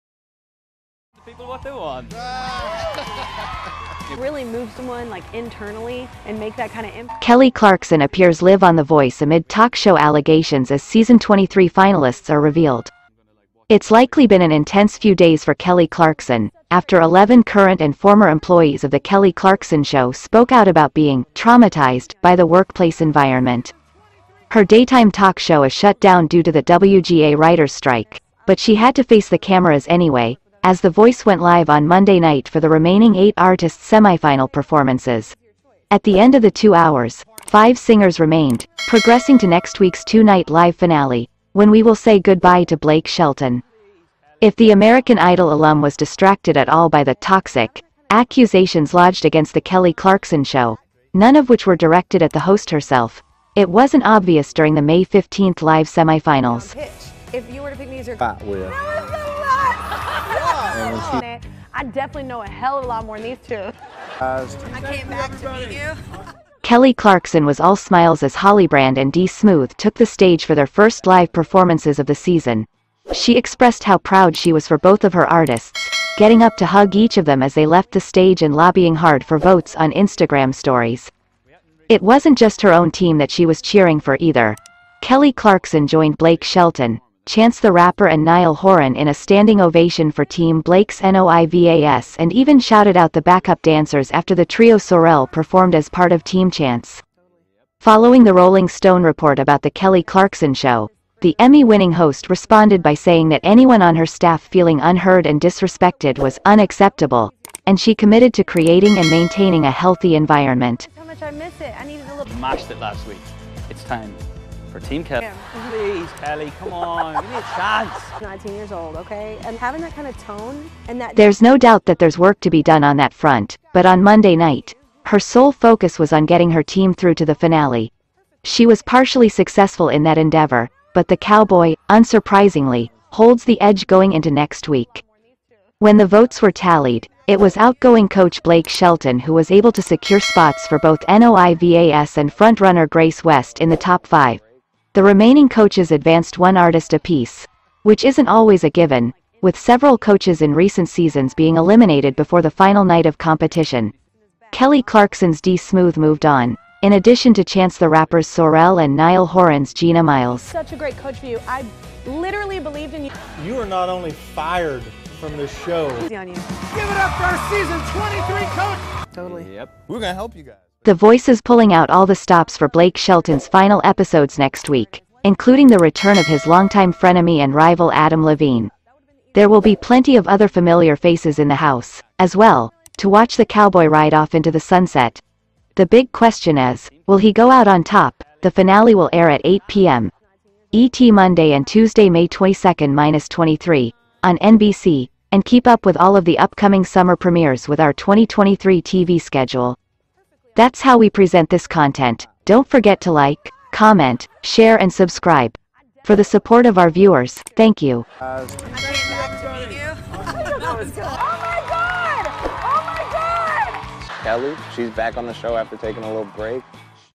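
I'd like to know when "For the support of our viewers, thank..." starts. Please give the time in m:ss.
3:26.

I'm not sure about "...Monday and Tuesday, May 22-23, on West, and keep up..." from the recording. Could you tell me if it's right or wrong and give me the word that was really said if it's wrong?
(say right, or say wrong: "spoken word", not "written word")
wrong: "NBC", not "West".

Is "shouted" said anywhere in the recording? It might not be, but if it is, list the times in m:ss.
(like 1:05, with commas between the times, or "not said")
1:32.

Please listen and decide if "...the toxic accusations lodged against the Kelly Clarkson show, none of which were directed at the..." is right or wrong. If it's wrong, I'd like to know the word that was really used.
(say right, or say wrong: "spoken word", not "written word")
right.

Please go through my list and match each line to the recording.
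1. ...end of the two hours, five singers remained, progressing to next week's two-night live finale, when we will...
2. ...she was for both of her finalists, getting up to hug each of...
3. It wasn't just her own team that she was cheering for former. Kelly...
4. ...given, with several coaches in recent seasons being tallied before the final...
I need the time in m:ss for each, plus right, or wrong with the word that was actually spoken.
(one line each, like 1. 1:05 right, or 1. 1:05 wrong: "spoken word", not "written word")
1. 0:36 right
2. 1:14 wrong: "artists", not "finalists"
3. 1:21 wrong: "either", not "former"
4. 2:28 wrong: "eliminated", not "tallied".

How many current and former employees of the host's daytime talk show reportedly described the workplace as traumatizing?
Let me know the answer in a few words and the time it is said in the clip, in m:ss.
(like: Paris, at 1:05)
11, at 0:17.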